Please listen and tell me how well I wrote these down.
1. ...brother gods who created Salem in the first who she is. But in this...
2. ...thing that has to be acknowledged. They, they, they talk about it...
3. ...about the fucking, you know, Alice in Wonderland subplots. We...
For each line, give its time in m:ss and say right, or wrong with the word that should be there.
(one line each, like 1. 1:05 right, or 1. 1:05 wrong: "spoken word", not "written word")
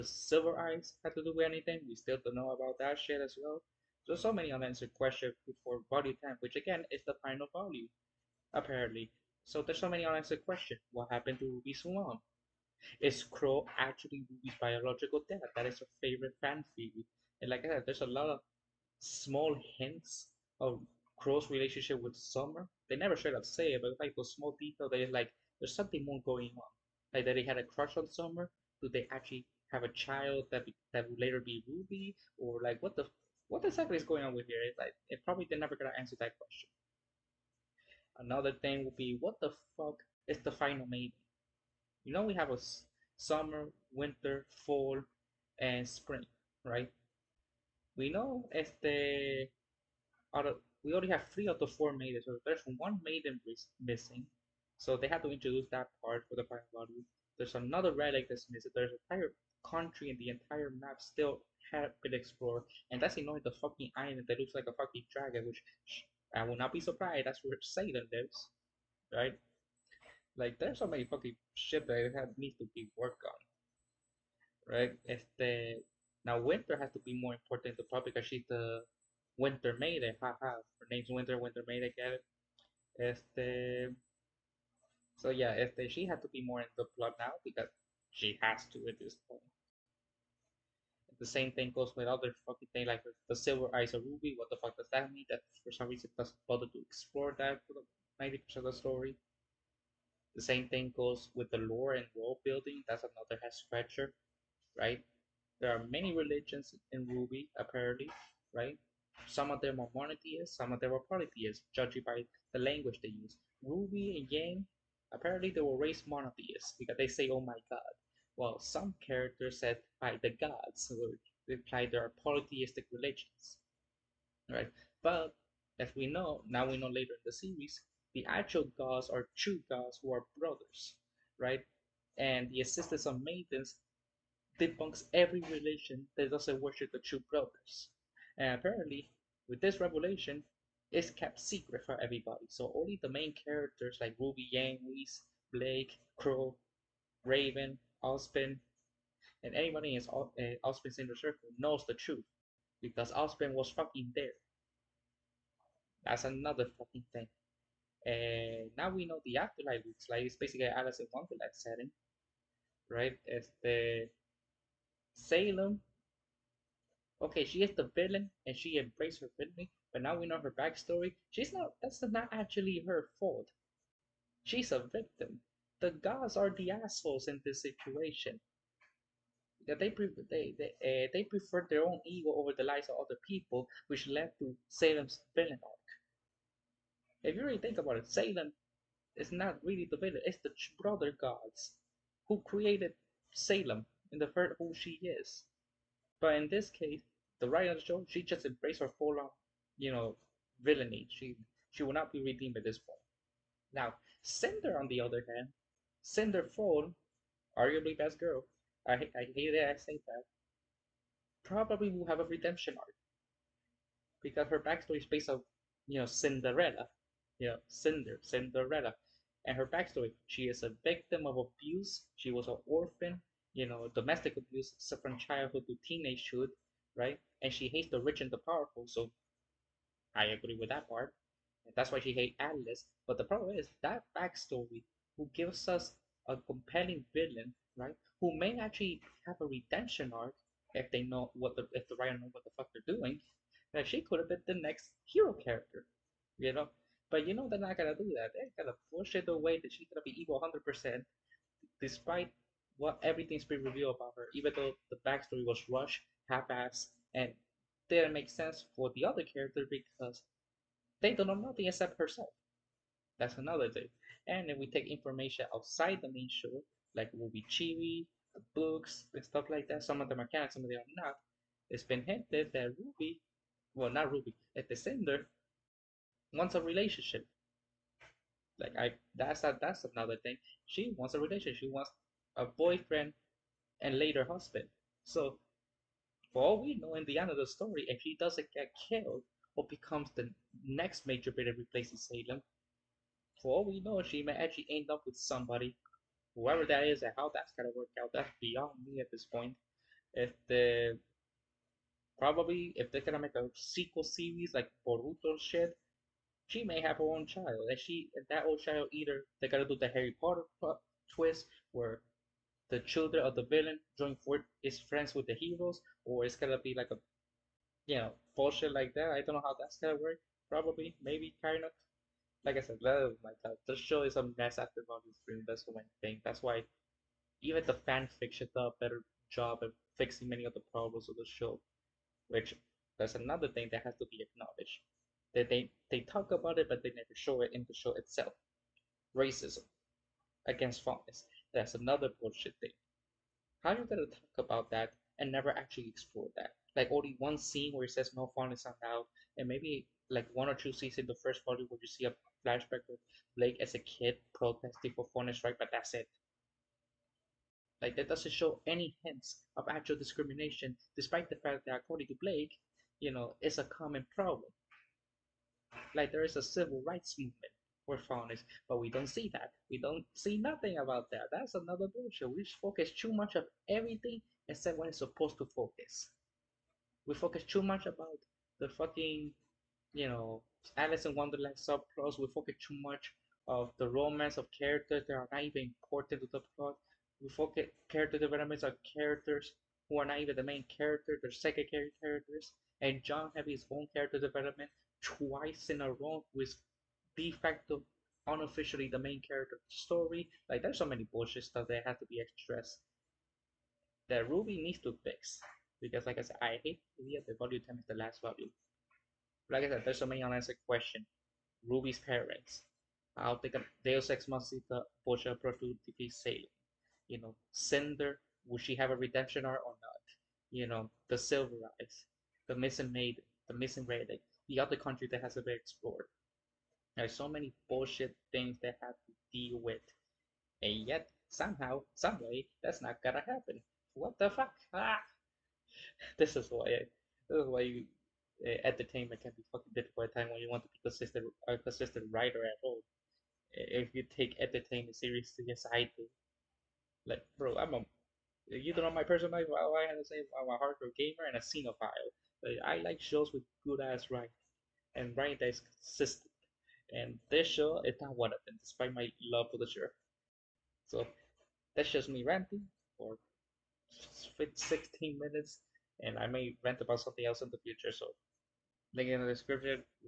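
1. 3:10 right
2. 5:33 right
3. 6:17 right.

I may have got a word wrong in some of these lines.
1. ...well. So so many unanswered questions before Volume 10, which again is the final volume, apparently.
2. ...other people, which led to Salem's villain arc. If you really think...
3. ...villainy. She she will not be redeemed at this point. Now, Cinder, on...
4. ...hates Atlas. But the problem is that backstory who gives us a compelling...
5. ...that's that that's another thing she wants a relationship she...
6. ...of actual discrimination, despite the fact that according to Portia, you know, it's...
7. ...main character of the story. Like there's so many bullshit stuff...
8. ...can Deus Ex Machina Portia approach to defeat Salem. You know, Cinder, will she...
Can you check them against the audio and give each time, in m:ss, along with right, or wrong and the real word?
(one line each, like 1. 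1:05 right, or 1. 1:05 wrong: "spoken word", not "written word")
1. 0:03 right
2. 3:03 right
3. 3:20 right
4. 3:52 right
5. 4:39 right
6. 5:59 wrong: "Blake", not "Portia"
7. 6:38 right
8. 6:53 right.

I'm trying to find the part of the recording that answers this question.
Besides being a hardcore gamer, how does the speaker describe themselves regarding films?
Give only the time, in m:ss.
7:31.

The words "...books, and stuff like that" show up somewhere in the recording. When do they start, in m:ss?
4:28.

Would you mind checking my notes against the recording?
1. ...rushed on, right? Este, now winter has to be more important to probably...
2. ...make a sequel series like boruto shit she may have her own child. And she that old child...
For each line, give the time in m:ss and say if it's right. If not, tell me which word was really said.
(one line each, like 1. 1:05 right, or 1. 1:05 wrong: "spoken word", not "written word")
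1. 1:12 wrong: "worked", not "rushed"
2. 5:03 right.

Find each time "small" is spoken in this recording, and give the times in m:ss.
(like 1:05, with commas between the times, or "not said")
0:18, 0:24.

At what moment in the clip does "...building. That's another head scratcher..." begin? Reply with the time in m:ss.
1:42.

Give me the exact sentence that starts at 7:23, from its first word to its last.
Eh, if you take entertainment seriously, yes, I do.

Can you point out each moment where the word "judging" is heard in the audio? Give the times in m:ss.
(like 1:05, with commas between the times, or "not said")
1:51.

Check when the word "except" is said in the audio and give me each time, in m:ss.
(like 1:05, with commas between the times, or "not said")
4:21, 6:14.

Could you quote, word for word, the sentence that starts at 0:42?
You know we have a summer, winter, fall, and spring, right?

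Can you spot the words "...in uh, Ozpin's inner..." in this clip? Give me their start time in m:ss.
2:29.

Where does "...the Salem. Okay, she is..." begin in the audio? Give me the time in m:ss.
2:43.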